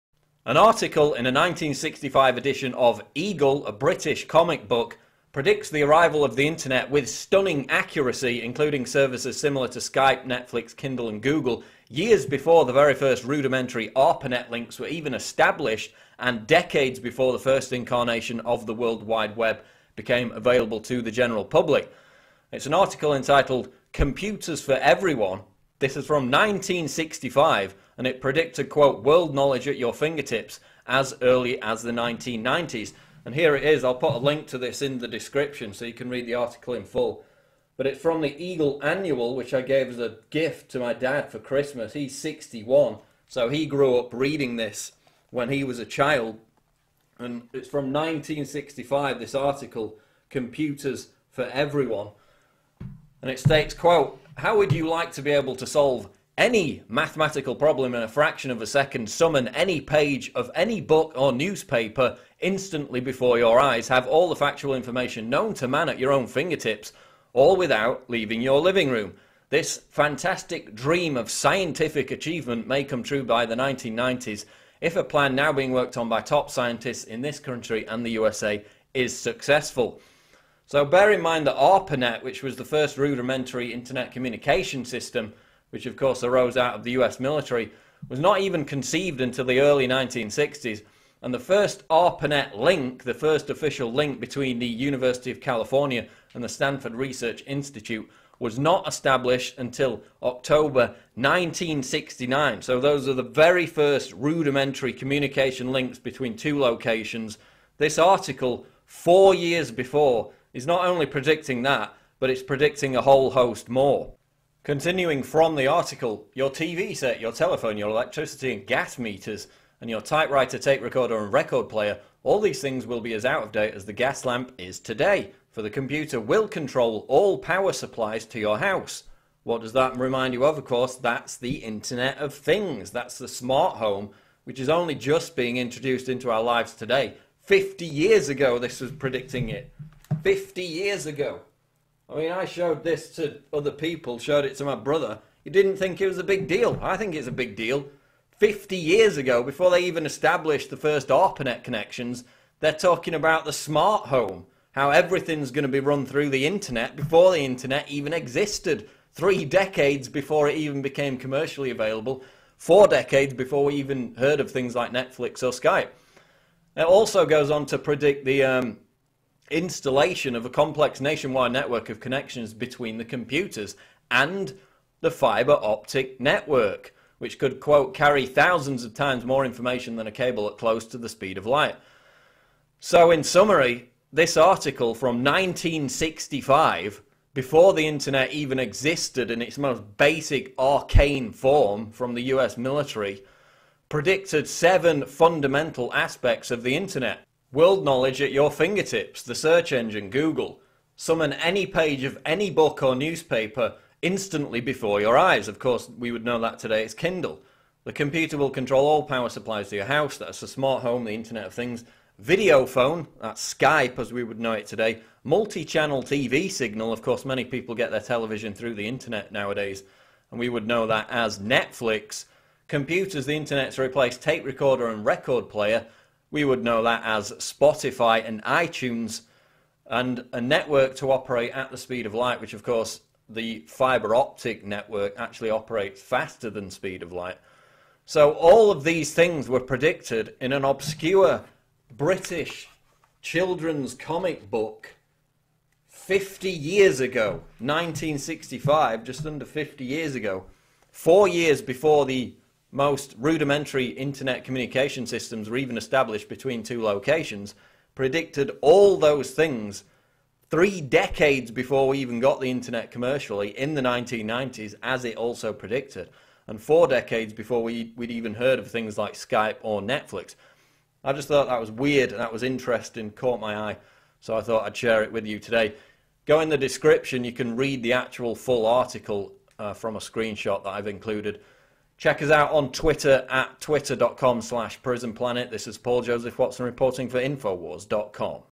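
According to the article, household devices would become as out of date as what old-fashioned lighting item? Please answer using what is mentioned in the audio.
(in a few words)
the gas lamp.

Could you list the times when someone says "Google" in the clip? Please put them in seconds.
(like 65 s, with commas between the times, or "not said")
11 s, 200 s.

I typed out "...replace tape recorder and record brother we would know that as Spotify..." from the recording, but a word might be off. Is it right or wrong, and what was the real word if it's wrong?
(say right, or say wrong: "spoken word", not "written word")
wrong: "player", not "brother".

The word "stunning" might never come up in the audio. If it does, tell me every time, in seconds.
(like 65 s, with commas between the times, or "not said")
7 s.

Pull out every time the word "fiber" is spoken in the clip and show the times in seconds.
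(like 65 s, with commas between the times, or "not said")
175 s, 233 s.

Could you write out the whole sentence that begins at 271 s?
I just thought that was weird and that was interesting, caught my eye, so I thought I'd share it with you today.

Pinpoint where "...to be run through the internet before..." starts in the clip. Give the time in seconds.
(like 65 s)
155 s.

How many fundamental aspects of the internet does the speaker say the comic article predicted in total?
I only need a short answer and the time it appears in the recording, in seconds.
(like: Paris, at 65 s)
7, at 194 s.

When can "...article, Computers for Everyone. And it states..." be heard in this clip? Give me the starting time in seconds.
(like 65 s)
49 s.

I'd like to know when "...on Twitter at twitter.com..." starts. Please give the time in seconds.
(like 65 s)
282 s.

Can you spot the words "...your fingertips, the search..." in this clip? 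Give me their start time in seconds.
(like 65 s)
198 s.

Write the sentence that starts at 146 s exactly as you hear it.
I think it's a big deal.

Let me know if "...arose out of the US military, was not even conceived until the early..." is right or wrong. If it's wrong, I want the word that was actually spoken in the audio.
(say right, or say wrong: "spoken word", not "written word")
right.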